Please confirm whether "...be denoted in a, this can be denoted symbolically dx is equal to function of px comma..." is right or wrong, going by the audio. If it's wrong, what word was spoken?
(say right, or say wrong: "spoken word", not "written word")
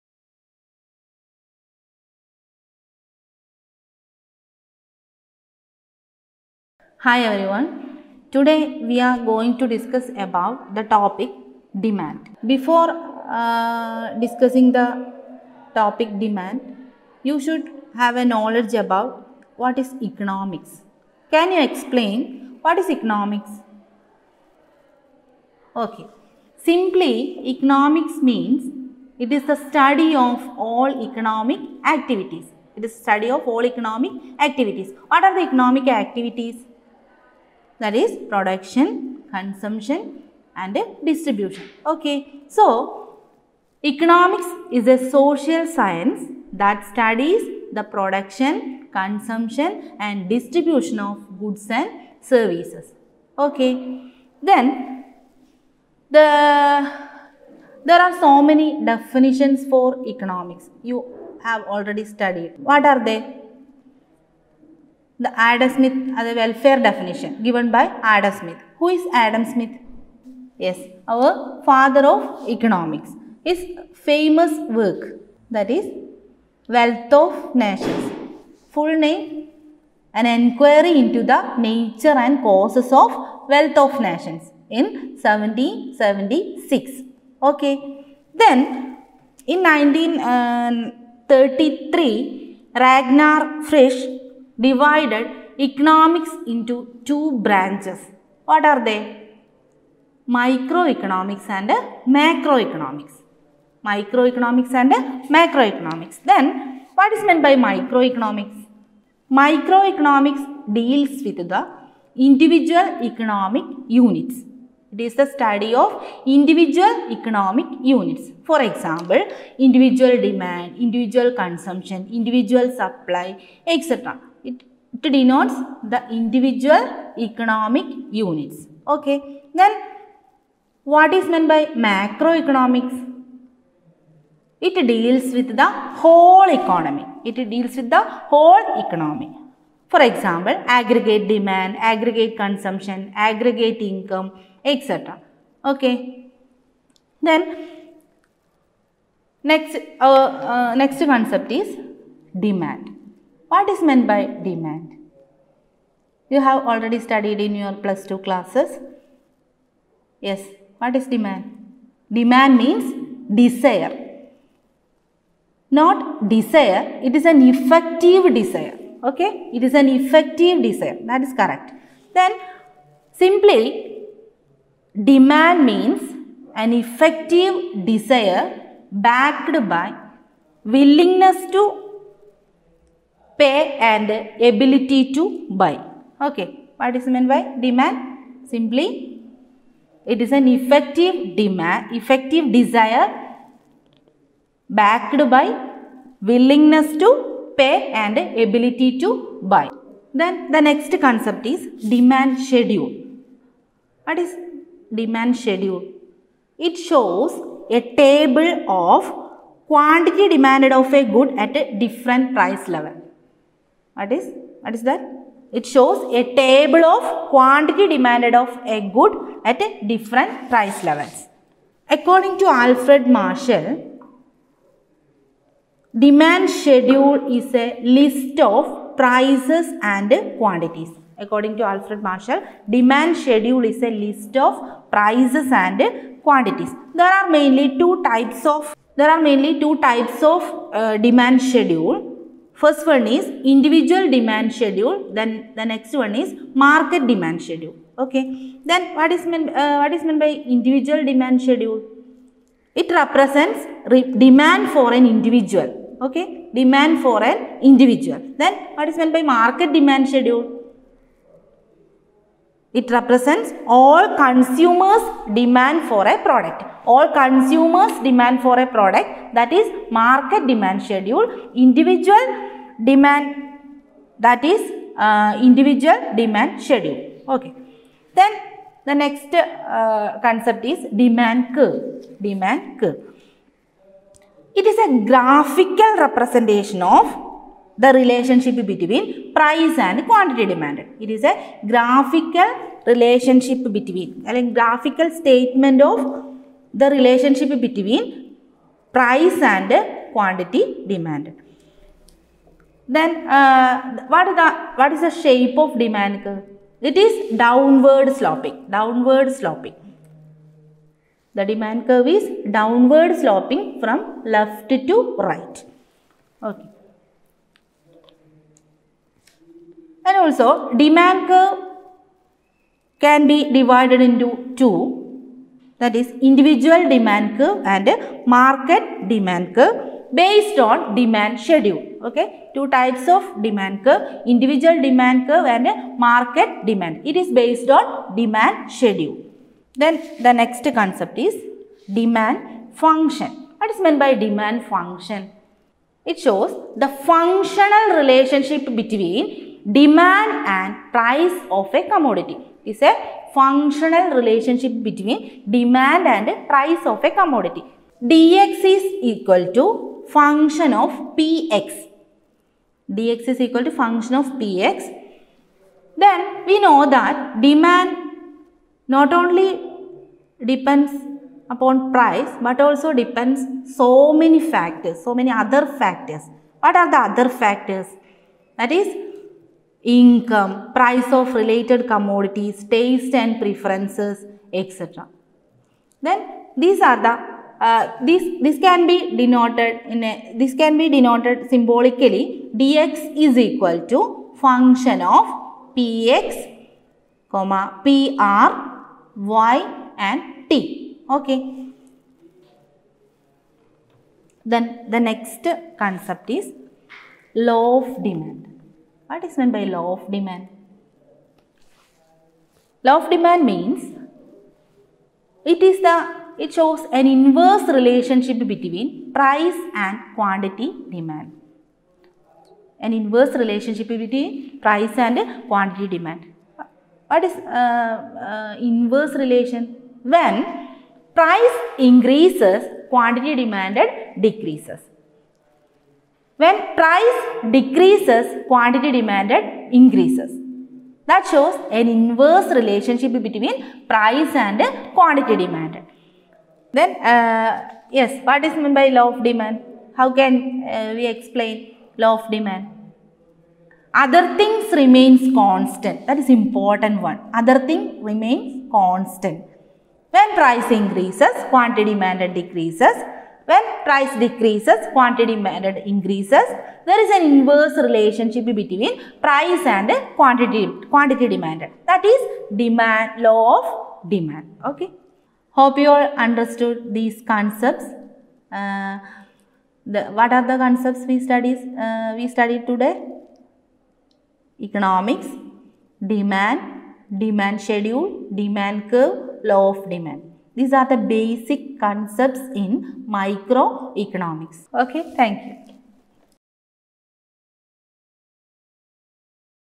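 right.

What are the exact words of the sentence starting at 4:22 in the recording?
It represents all consumers demand for a product.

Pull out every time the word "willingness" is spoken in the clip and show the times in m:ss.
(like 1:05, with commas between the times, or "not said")
3:00, 3:16.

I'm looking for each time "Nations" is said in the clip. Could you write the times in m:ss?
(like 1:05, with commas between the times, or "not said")
1:17, 1:24.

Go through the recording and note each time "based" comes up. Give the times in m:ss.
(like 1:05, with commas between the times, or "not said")
5:30, 5:37.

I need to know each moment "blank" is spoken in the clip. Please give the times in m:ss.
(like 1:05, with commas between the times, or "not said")
not said.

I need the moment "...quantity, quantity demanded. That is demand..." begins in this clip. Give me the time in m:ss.
7:50.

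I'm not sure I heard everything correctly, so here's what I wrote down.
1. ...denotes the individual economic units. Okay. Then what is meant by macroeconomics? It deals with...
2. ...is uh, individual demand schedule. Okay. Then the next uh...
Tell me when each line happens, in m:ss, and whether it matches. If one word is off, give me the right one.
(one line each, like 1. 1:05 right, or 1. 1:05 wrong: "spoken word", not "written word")
1. 2:05 right
2. 4:34 right.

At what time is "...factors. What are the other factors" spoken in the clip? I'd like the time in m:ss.
6:15.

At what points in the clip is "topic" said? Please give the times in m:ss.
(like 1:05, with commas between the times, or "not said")
0:10, 0:15.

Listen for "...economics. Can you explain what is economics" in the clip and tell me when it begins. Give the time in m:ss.
0:20.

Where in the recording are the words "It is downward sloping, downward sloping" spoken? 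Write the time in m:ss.
5:06.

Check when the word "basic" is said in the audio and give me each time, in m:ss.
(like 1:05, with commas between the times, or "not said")
8:10.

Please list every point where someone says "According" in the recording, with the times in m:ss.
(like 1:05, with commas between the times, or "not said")
3:41, 3:51.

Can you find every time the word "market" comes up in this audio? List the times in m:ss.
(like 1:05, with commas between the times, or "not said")
4:06, 4:19, 4:29, 5:28, 5:35.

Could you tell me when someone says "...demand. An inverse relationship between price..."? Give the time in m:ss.
7:00.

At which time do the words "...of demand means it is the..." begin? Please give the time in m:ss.
6:52.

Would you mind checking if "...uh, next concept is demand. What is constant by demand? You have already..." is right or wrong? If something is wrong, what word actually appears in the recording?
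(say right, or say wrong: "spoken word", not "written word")
wrong: "meant", not "constant".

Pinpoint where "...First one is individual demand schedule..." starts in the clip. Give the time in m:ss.
4:02.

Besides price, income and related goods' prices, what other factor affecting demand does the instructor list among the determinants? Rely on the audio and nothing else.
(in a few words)
taste and preferences.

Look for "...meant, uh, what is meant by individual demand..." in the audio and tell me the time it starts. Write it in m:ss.
4:09.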